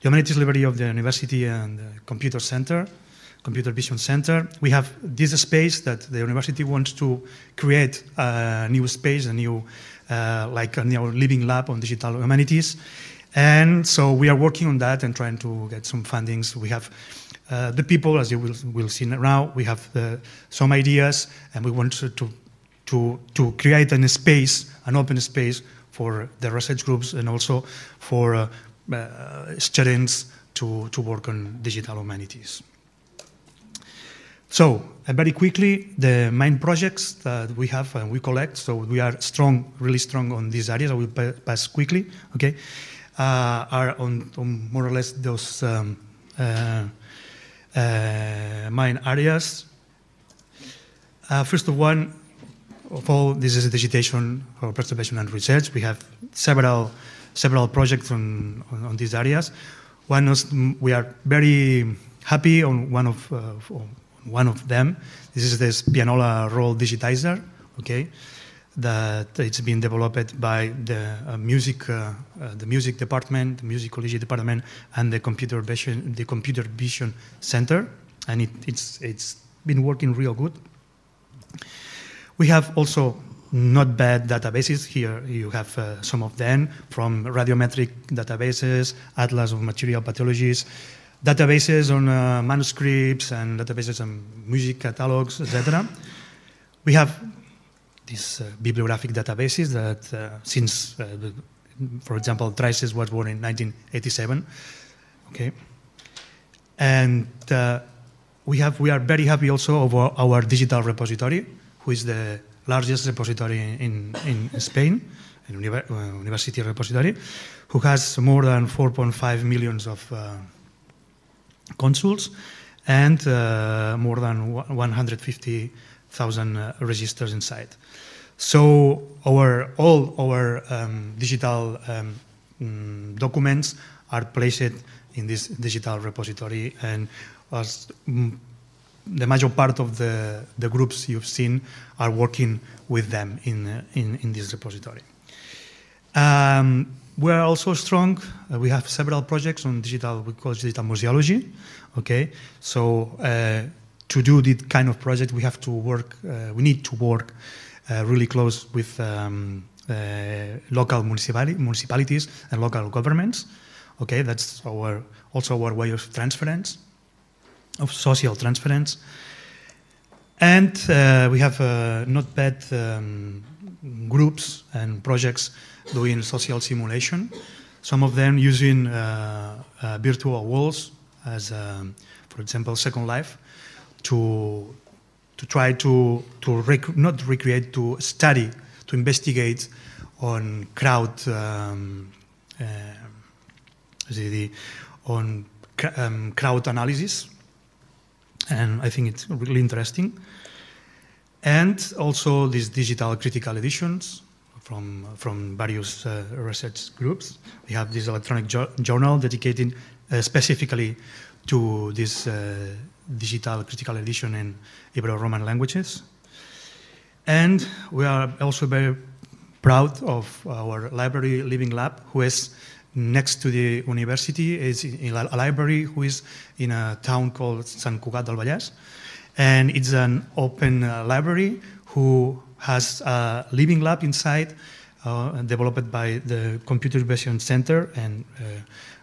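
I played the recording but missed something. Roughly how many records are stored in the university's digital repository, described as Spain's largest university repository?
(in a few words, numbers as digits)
150,000.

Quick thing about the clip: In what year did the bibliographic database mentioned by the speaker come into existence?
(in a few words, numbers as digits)
1987.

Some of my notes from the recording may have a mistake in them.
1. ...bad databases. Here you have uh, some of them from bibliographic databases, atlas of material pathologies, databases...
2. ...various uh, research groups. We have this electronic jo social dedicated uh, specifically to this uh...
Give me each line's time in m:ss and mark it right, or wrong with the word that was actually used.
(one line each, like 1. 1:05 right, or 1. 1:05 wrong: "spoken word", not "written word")
1. 1:23 wrong: "radiometric", not "bibliographic"
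2. 3:25 wrong: "journal", not "social".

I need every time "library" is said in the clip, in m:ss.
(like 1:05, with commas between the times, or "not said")
0:00, 3:40, 3:45, 3:51.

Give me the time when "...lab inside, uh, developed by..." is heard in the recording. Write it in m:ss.
3:53.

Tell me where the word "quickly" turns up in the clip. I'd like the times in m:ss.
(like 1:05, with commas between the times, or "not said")
0:35, 0:41.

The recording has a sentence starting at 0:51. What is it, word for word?
Uh, first of one, of all, this is digitation for preservation and research.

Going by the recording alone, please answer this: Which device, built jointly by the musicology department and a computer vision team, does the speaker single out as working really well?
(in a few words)
Pianola roll digitizer.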